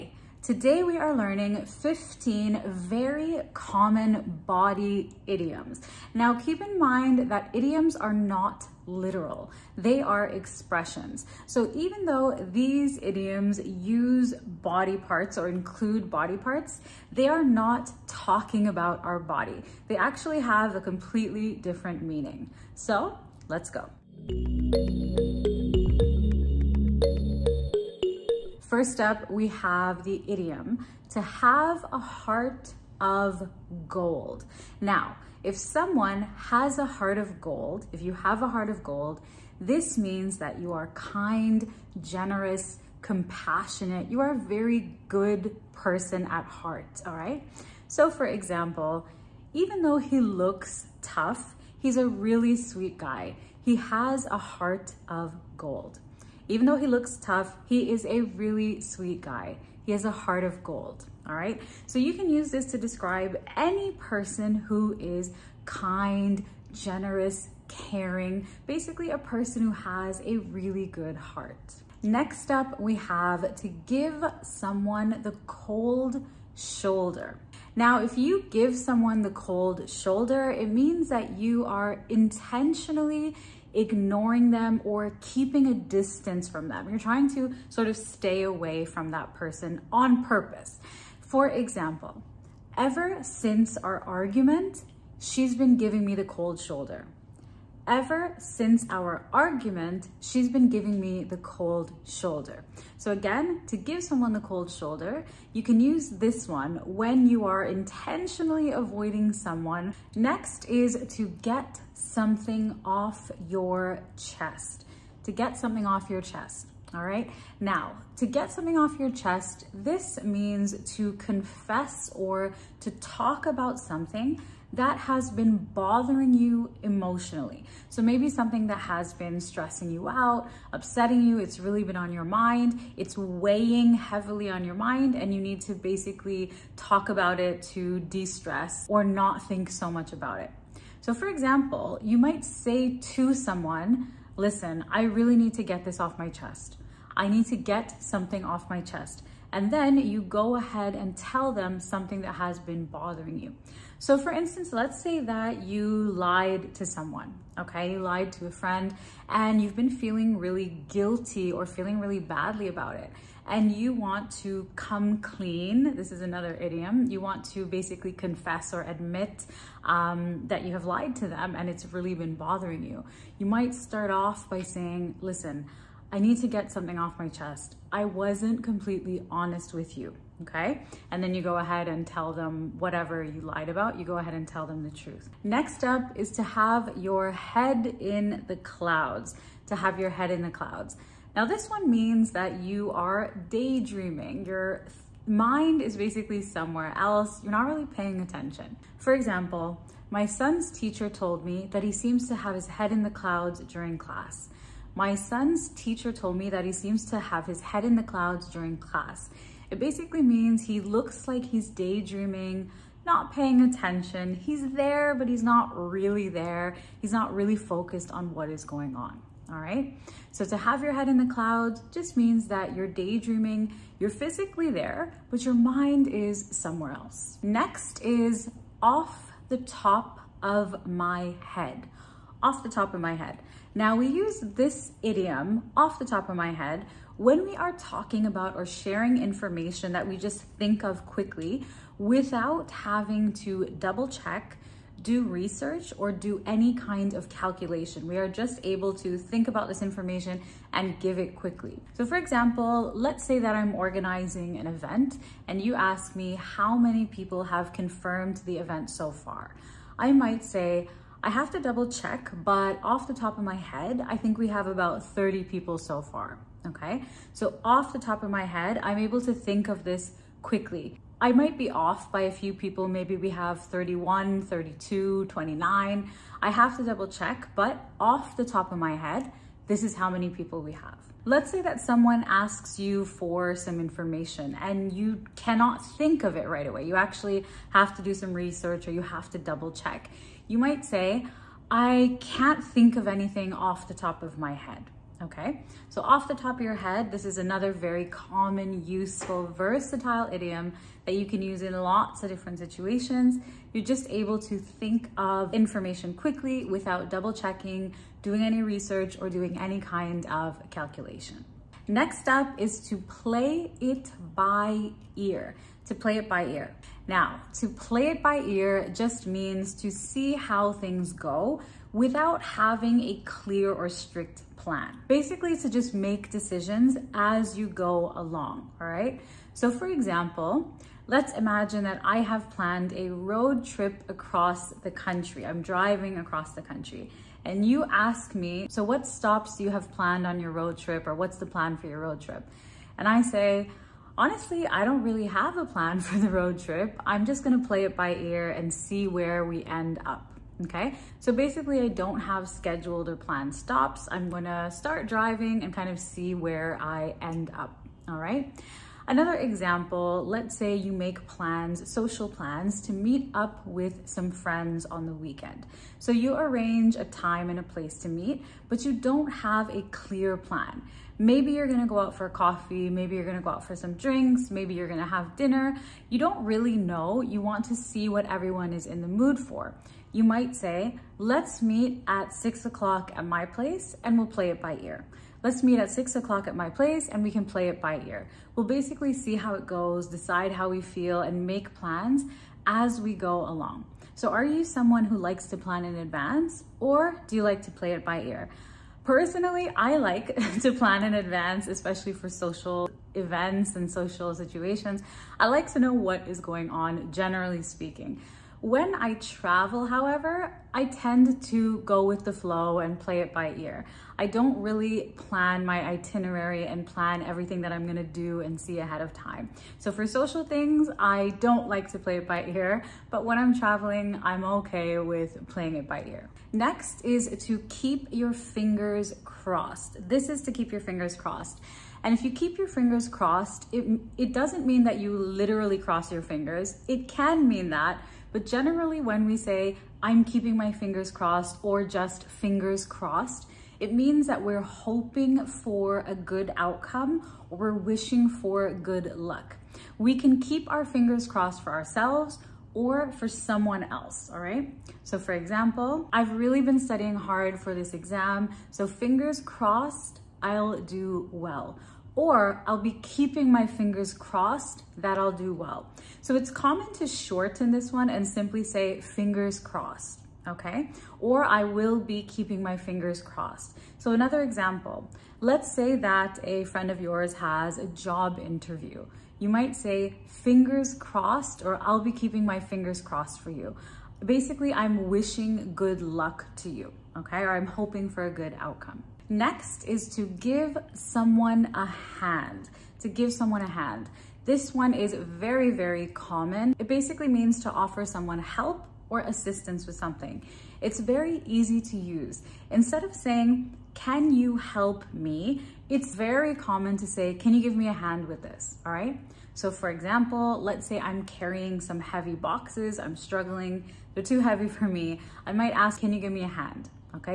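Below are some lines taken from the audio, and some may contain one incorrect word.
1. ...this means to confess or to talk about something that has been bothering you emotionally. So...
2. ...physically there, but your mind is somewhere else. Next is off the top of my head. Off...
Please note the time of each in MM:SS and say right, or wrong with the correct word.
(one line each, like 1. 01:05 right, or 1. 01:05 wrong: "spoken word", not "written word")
1. 01:59 right
2. 03:44 right.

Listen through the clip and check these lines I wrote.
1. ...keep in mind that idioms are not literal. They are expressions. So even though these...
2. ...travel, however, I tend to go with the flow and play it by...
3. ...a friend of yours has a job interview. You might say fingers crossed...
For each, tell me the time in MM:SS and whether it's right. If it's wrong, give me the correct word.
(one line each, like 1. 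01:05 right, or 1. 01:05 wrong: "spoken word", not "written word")
1. 00:06 right
2. 06:49 right
3. 07:56 right.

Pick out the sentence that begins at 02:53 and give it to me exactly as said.
You might start off by saying, listen, I need to get something off my chest.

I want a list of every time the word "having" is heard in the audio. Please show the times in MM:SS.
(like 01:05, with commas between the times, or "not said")
04:02, 05:22.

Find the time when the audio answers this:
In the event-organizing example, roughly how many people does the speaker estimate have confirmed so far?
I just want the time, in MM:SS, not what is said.
04:25.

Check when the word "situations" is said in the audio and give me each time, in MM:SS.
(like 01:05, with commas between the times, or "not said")
05:02, 06:44.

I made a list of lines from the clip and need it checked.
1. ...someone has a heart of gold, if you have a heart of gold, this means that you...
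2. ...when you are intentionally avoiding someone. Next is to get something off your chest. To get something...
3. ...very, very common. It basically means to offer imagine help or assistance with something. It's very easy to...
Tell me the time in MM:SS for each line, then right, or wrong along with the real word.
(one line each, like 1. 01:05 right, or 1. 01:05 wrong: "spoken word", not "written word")
1. 00:35 right
2. 01:46 right
3. 08:15 wrong: "someone", not "imagine".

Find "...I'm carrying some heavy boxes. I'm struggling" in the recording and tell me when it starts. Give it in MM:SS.
08:30.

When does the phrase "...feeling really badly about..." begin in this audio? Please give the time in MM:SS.
02:41.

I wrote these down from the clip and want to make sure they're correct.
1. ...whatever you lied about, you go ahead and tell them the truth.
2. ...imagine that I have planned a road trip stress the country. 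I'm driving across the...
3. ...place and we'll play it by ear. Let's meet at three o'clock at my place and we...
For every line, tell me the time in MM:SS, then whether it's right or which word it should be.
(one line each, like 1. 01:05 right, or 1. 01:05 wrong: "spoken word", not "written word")
1. 03:02 right
2. 05:31 wrong: "across", not "stress"
3. 06:23 wrong: "six", not "three".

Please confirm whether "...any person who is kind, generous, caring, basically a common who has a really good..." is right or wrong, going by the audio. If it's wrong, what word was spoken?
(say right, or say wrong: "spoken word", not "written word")
wrong: "person", not "common".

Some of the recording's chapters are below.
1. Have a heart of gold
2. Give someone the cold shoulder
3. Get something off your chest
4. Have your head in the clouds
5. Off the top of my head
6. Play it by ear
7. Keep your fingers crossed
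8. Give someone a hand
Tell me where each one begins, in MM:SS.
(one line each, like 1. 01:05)
1. 00:28
2. 01:11
3. 01:50
4. 03:05
5. 03:47
6. 05:11
7. 07:07
8. 08:08.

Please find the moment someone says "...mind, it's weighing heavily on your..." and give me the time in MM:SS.
02:12.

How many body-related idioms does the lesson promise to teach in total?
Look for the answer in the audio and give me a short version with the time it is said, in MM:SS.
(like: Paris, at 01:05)
15, at 00:01.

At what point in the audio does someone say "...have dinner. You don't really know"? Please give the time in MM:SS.
06:15.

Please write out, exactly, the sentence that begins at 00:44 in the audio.
You are a very good person at heart, all right?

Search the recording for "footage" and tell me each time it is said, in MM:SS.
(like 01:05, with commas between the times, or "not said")
not said.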